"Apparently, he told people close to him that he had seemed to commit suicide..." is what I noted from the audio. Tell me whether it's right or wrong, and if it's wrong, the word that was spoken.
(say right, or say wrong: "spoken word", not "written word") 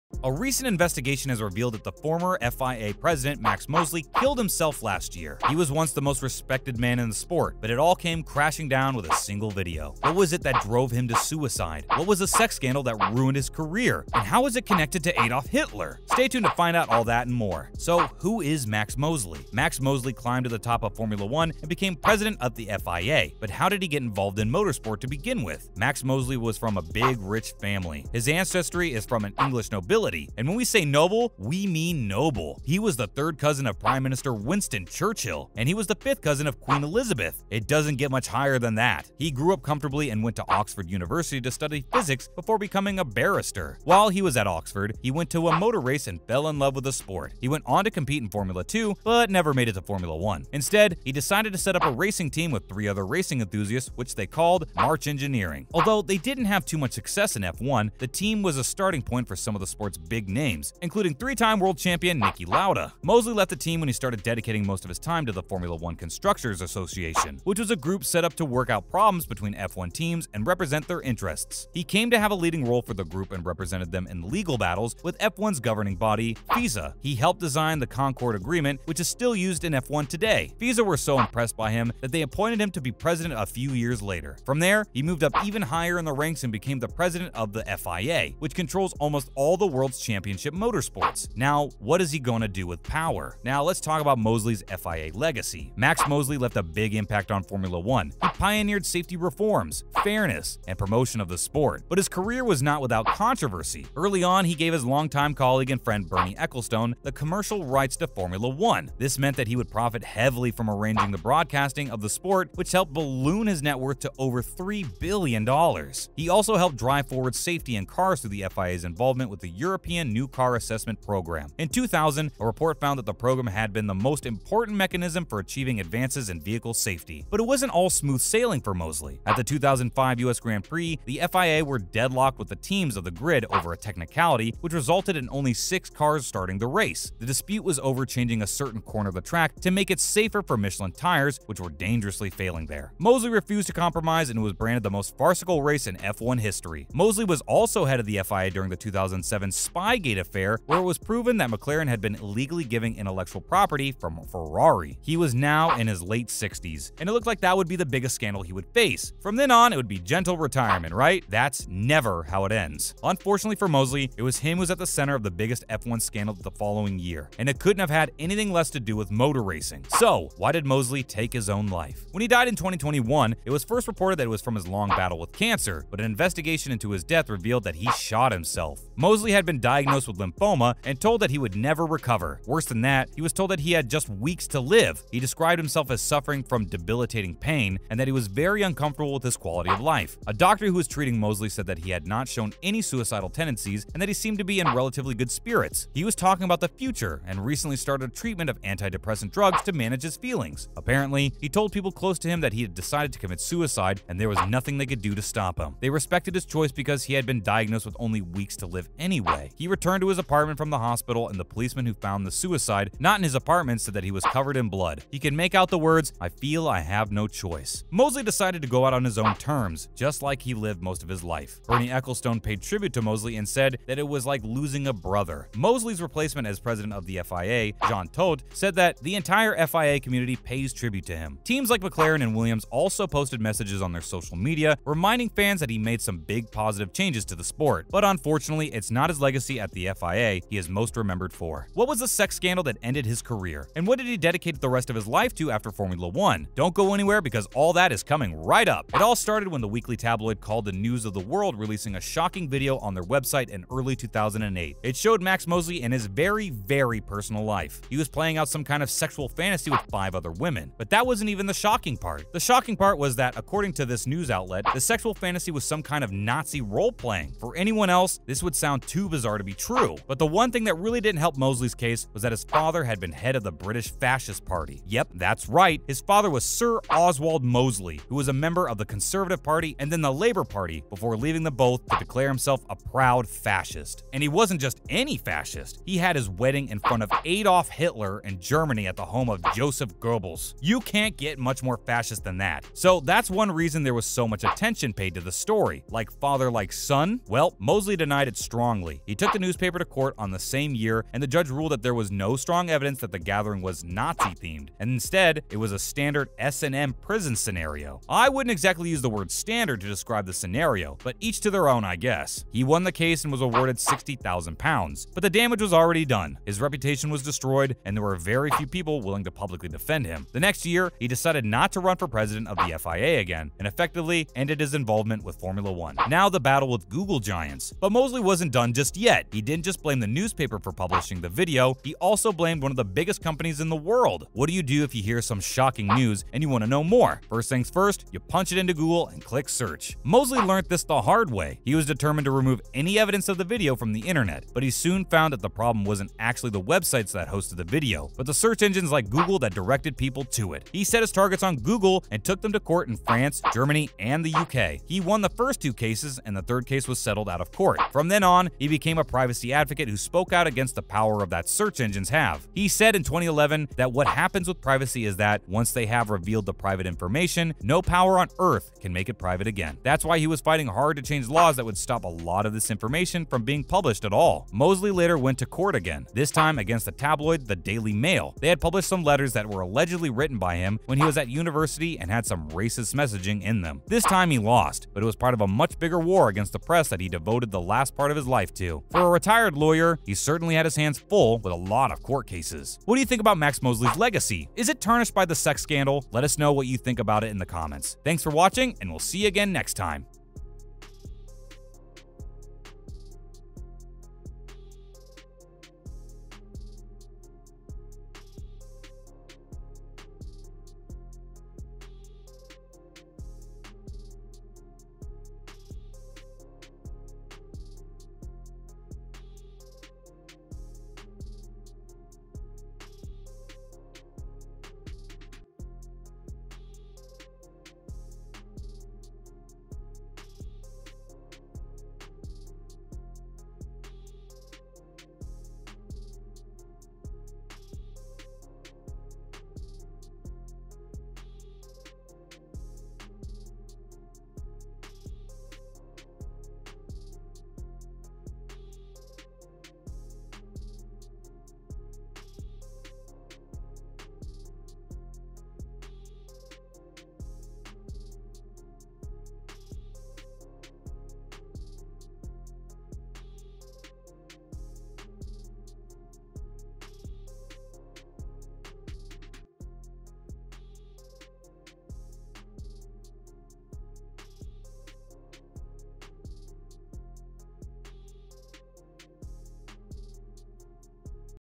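wrong: "decided", not "seemed".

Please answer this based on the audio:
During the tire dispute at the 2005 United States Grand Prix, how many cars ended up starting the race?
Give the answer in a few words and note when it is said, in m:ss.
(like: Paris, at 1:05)
6, at 2:15.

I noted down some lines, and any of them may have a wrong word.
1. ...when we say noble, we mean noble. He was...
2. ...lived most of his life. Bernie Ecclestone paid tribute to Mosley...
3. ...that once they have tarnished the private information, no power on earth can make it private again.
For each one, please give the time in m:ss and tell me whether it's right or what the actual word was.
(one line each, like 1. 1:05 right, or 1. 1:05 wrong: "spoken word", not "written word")
1. 0:30 right
2. 3:40 right
3. 6:05 wrong: "revealed", not "tarnished".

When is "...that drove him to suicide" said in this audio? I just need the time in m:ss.
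0:10.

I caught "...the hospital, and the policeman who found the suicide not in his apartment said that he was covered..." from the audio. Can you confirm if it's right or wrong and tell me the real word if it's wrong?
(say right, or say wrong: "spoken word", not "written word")
right.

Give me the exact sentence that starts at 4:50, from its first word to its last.
You can't get much more fascist than that.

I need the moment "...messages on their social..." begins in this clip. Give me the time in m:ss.
3:53.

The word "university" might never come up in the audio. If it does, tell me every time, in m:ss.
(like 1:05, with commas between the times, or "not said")
0:40, 6:21.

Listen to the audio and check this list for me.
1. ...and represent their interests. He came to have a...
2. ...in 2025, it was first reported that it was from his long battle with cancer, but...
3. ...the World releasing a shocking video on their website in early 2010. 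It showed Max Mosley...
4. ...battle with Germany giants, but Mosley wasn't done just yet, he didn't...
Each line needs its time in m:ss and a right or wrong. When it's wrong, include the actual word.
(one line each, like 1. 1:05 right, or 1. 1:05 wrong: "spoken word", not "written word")
1. 1:10 right
2. 2:52 wrong: "2021", not "2025"
3. 4:11 wrong: "2008", not "2010"
4. 5:26 wrong: "Google", not "Germany".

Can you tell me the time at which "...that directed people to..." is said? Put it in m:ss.
5:49.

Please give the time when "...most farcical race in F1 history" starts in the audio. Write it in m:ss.
2:24.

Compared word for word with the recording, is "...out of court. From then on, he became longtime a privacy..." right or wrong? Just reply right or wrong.
wrong.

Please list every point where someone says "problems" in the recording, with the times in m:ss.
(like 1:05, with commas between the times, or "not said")
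1:08, 5:45.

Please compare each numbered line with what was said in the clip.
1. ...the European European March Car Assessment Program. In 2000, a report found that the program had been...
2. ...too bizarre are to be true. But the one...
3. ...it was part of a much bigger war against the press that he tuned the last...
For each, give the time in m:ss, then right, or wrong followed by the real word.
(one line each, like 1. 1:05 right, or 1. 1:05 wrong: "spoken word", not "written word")
1. 1:59 wrong: "New", not "March"
2. 4:28 right
3. 6:25 wrong: "devoted", not "tuned".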